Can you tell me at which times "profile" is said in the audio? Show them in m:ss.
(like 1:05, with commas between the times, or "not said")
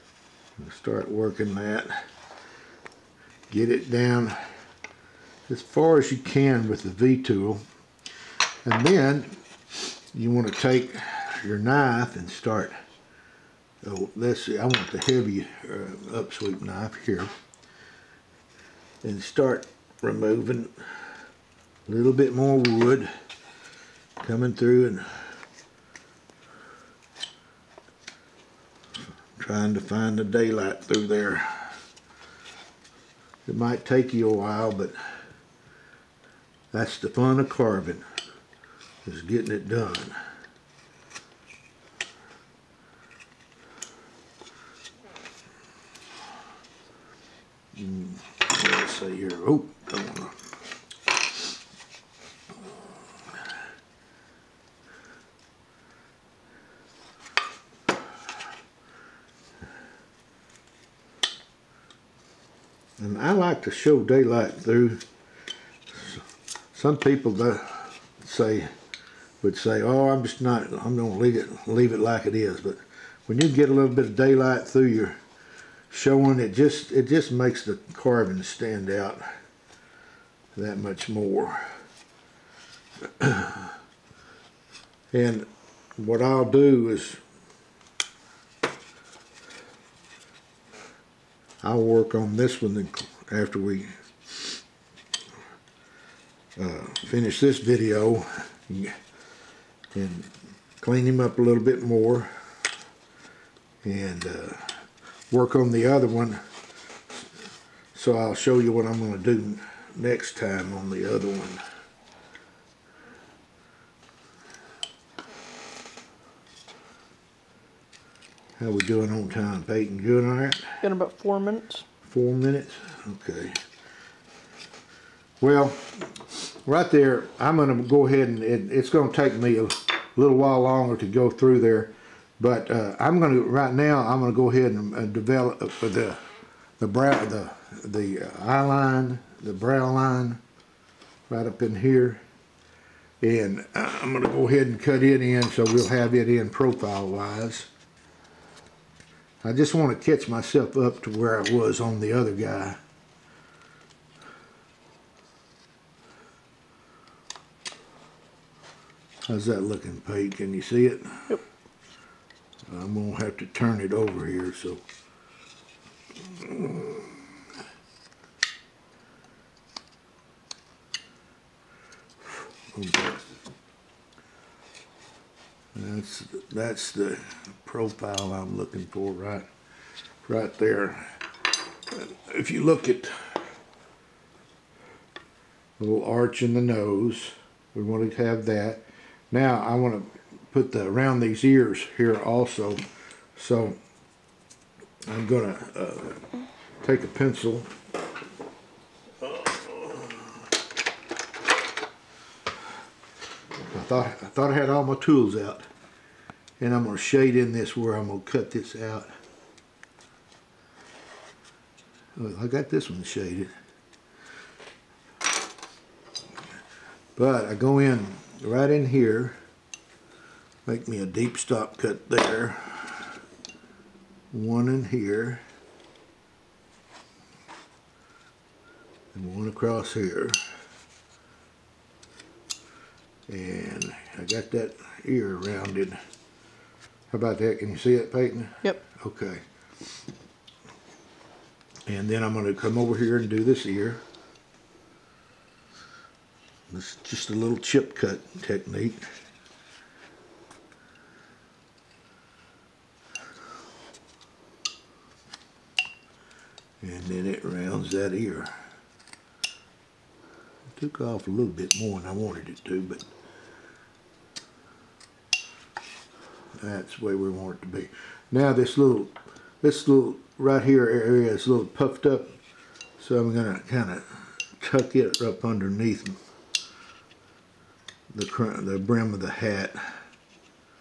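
2:26, 2:57.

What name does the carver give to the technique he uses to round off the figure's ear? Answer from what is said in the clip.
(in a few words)
chip cut technique.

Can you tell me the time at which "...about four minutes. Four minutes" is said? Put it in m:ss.
2:00.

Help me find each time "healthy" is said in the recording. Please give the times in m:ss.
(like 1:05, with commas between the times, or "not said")
not said.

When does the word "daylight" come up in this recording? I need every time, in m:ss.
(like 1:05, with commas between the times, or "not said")
0:30, 1:04, 1:14.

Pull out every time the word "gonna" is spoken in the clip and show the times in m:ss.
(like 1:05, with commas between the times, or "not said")
1:10, 4:33.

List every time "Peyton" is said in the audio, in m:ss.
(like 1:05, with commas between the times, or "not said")
1:59, 3:58.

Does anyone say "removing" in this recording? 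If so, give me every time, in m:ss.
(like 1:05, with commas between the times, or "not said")
0:20.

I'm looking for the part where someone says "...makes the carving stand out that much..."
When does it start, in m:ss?
1:17.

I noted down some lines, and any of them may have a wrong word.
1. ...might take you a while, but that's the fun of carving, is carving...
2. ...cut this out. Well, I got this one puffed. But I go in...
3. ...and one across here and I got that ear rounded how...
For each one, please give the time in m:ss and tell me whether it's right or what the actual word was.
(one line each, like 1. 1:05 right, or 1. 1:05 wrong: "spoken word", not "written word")
1. 0:33 wrong: "getting", not "carving"
2. 3:28 wrong: "shaded", not "puffed"
3. 3:49 right.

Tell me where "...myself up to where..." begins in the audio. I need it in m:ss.
2:30.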